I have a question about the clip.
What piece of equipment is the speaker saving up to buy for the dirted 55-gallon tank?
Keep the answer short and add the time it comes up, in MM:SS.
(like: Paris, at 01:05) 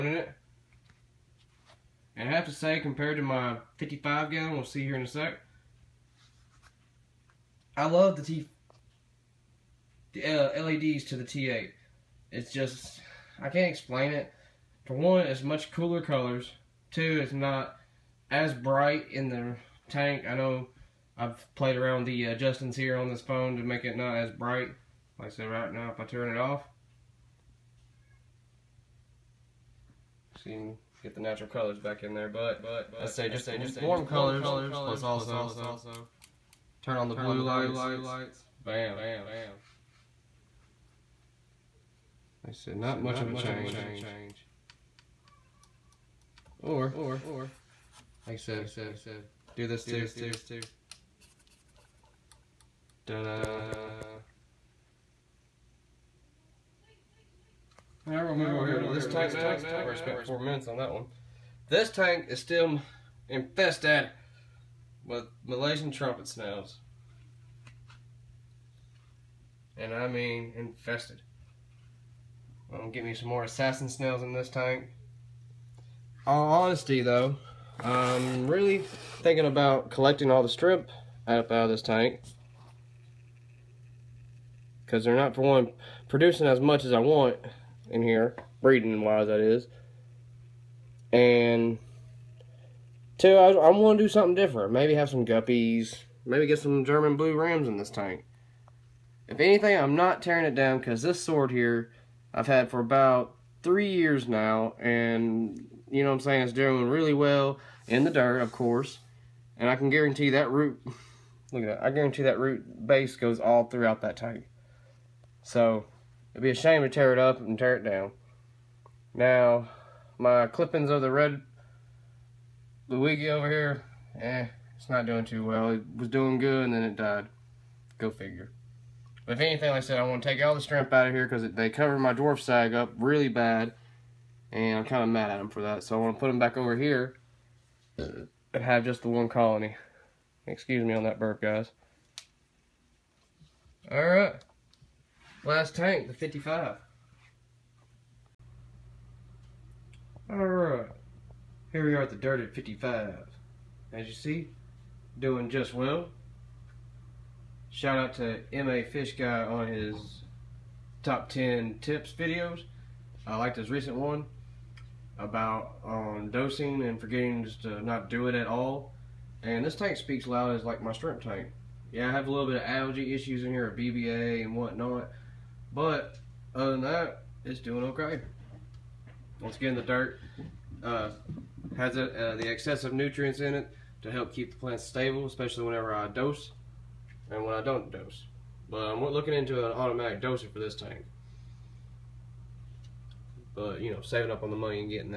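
automatic doser, at 03:09.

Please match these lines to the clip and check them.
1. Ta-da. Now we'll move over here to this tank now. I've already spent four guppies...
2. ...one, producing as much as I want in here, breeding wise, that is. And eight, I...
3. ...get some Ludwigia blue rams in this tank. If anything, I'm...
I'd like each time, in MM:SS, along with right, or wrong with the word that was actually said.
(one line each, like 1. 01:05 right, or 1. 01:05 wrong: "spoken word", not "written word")
1. 00:53 wrong: "minutes", not "guppies"
2. 01:25 wrong: "two", not "eight"
3. 01:36 wrong: "German", not "Ludwigia".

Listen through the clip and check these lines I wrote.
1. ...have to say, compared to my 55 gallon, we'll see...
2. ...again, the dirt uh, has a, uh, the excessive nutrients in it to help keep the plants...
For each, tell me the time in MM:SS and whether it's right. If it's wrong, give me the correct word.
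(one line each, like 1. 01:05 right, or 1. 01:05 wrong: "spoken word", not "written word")
1. 00:02 right
2. 02:59 right.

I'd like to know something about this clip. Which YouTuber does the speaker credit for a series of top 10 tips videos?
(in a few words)
MA Fish Guy.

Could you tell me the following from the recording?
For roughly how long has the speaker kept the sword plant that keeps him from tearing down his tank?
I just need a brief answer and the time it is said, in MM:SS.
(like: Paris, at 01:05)
3 years, at 01:43.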